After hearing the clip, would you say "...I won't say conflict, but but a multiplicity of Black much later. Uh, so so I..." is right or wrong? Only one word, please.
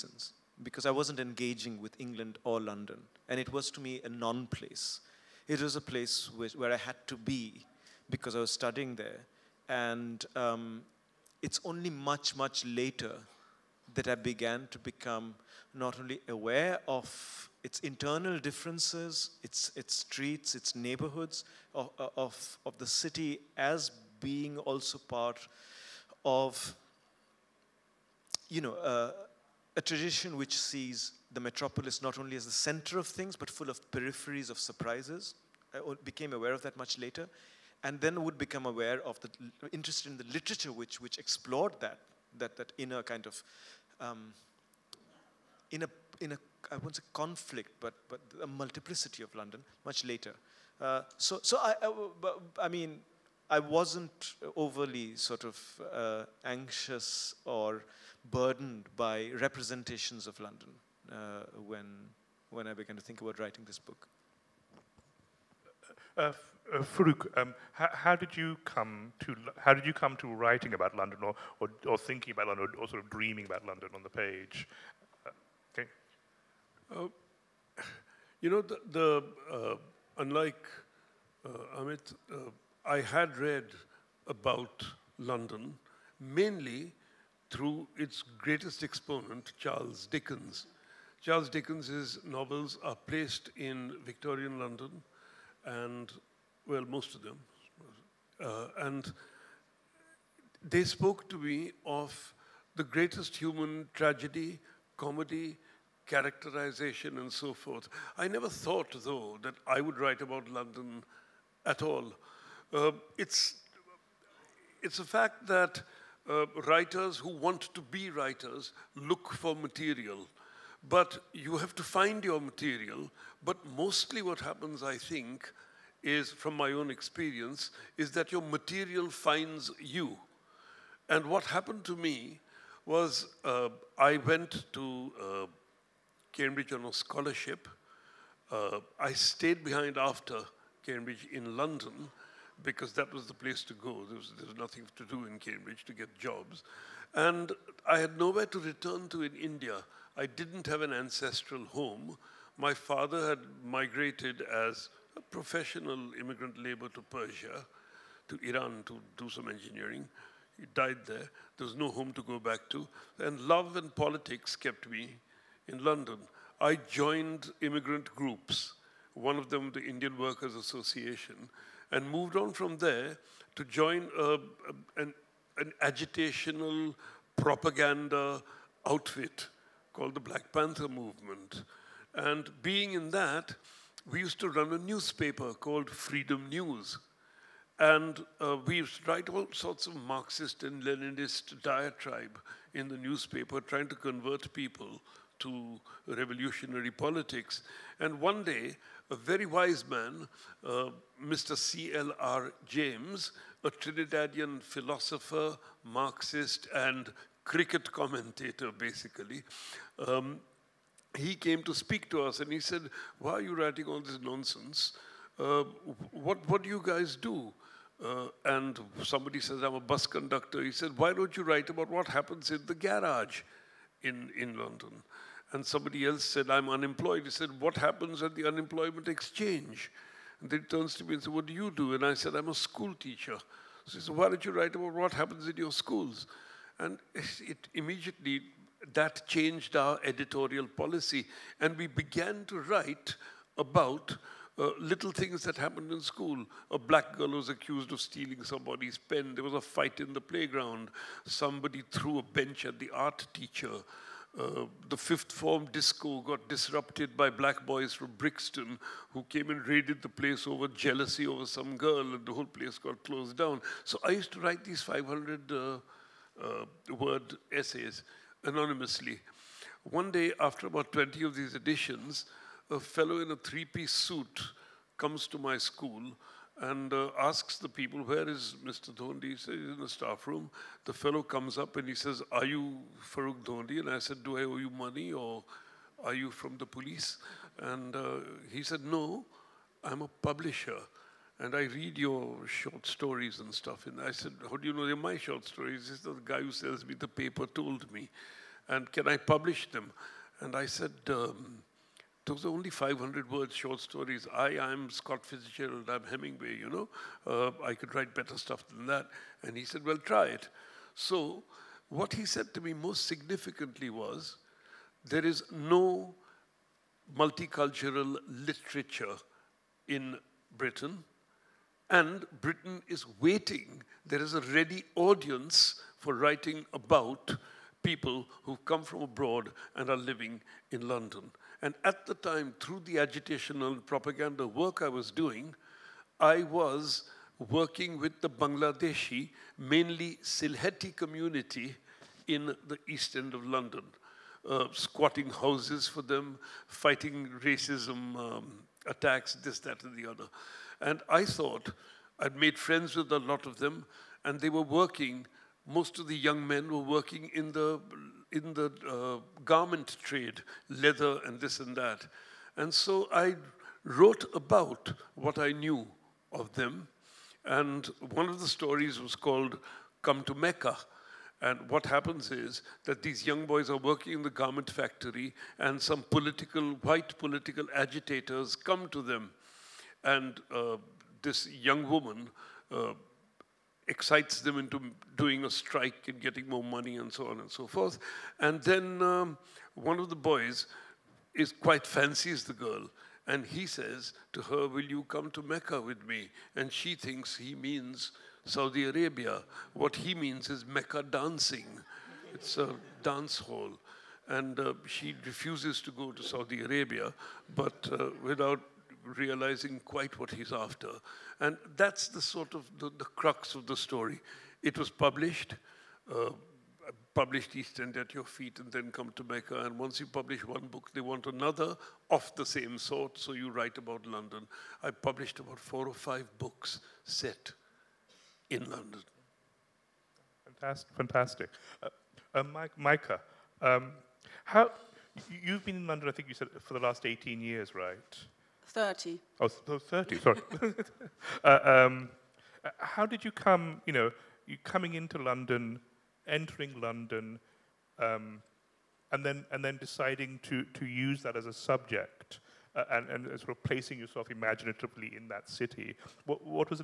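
wrong.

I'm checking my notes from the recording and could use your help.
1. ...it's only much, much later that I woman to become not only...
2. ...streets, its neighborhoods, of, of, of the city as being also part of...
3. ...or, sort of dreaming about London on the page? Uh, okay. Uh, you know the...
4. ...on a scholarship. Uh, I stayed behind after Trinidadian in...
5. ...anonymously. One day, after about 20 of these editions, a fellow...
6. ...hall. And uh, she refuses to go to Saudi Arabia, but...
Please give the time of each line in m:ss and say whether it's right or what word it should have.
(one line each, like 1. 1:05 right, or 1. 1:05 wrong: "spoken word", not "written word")
1. 0:11 wrong: "began", not "woman"
2. 0:19 right
3. 1:12 right
4. 2:16 wrong: "Cambridge", not "Trinidadian"
5. 4:28 right
6. 6:43 right.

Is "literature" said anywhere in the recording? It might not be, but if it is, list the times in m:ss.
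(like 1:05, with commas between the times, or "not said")
0:40, 5:18.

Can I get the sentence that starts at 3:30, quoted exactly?
Um, he came to speak to us and he said, Why are you writing all this nonsense?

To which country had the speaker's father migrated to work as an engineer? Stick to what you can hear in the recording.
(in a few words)
Persia.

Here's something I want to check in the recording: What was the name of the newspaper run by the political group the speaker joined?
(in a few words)
Freedom News.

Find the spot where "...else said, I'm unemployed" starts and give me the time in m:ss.
3:46.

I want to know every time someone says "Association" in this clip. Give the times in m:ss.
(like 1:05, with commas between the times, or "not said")
2:50.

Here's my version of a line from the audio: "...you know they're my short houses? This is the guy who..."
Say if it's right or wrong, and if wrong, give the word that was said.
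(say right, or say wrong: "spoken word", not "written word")
wrong: "stories", not "houses".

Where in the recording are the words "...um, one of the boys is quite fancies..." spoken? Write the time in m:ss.
6:29.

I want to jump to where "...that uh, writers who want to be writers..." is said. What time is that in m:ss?
1:55.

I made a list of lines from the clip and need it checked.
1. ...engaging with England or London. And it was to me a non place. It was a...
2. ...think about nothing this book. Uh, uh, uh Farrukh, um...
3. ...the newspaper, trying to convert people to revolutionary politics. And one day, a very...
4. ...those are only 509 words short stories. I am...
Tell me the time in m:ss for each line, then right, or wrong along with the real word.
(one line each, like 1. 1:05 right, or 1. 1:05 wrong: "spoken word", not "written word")
1. 0:01 right
2. 1:03 wrong: "writing", not "nothing"
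3. 3:12 right
4. 5:02 wrong: "500", not "509".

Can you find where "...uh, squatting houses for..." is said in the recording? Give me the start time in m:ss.
5:44.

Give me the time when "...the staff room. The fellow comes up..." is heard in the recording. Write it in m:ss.
4:39.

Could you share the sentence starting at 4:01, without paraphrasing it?
And we began to write about uh, little things that happened in school.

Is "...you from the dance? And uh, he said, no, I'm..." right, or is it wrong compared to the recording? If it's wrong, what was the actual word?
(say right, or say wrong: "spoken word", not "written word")
wrong: "police", not "dance".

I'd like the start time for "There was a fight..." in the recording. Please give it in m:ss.
4:09.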